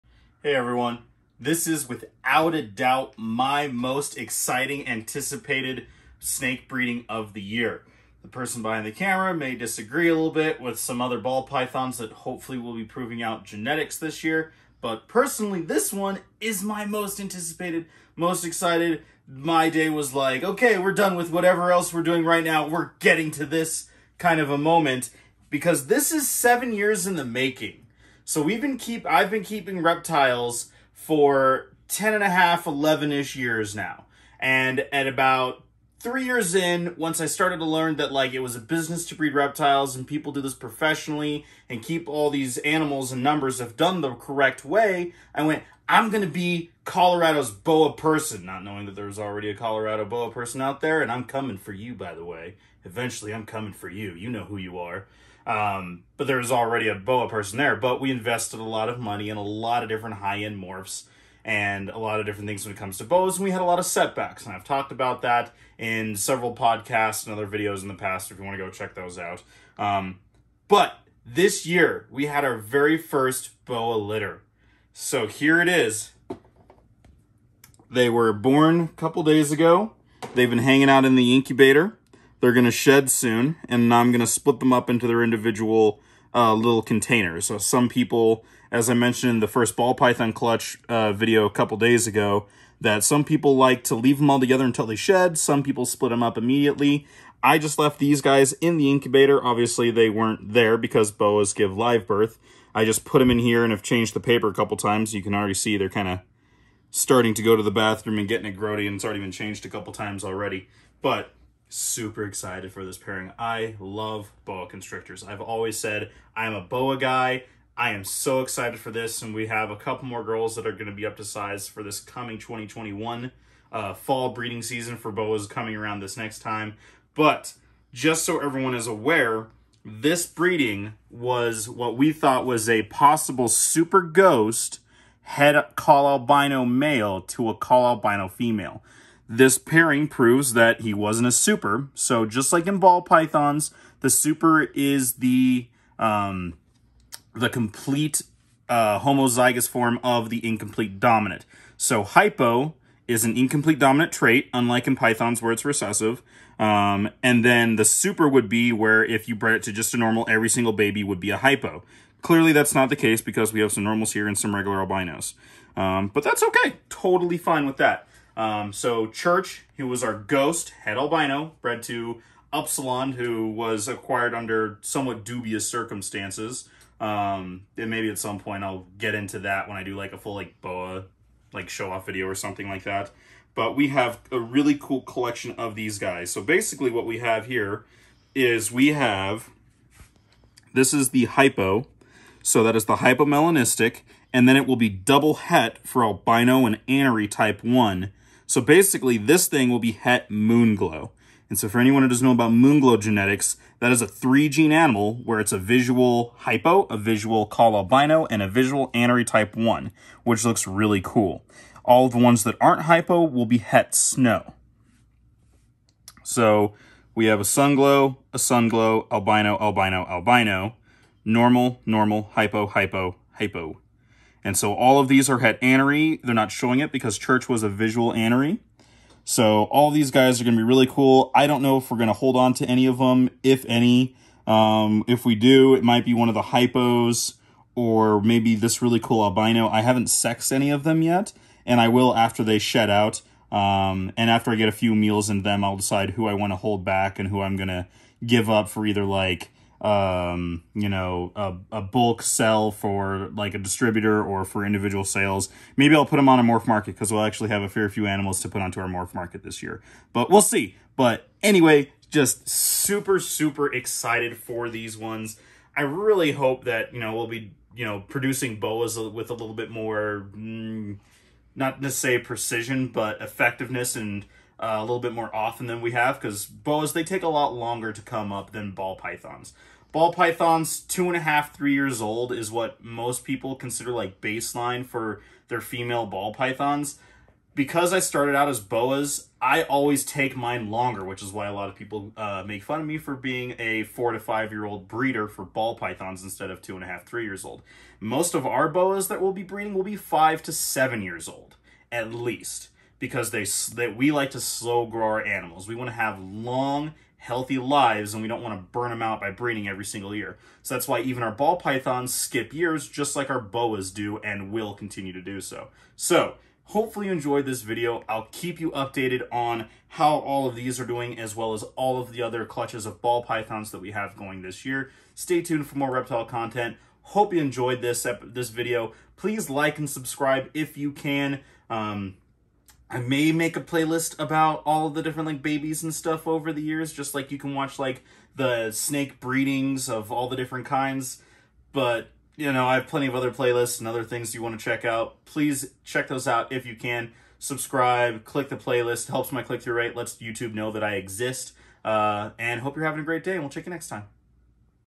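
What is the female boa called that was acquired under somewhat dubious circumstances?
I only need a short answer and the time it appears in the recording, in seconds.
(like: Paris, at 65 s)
Upsilon, at 172 s.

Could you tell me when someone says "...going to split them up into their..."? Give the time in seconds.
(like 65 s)
84 s.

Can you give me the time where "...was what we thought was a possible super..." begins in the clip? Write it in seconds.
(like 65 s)
131 s.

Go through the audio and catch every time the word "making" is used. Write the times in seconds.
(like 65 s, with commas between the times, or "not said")
27 s.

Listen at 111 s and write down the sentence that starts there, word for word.
But super excited for this pairing.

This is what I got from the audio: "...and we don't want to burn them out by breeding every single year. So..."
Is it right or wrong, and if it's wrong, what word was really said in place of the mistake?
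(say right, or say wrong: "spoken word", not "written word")
right.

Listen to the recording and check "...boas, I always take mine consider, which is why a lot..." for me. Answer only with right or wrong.
wrong.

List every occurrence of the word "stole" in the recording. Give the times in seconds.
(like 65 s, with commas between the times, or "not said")
not said.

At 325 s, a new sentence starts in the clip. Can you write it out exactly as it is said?
Stay tuned for more reptile content.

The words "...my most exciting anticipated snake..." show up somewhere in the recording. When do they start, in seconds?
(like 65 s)
3 s.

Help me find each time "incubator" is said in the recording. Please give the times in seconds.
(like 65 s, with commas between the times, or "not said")
81 s, 98 s.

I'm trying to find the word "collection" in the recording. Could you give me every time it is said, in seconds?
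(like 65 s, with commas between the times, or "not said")
185 s.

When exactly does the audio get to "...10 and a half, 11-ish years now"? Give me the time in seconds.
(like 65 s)
31 s.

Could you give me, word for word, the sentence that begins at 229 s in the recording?
So all these guys are going to be really cool.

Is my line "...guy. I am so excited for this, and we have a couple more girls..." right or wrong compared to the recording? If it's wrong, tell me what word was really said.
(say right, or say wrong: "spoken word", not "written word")
right.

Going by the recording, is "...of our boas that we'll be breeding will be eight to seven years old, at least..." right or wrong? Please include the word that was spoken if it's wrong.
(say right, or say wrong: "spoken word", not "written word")
wrong: "five", not "eight".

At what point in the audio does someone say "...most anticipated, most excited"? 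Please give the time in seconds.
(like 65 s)
16 s.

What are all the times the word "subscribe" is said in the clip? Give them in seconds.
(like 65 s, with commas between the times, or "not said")
329 s, 347 s.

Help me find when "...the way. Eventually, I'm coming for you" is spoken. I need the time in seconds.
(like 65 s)
52 s.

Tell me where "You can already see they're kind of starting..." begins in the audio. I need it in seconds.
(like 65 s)
105 s.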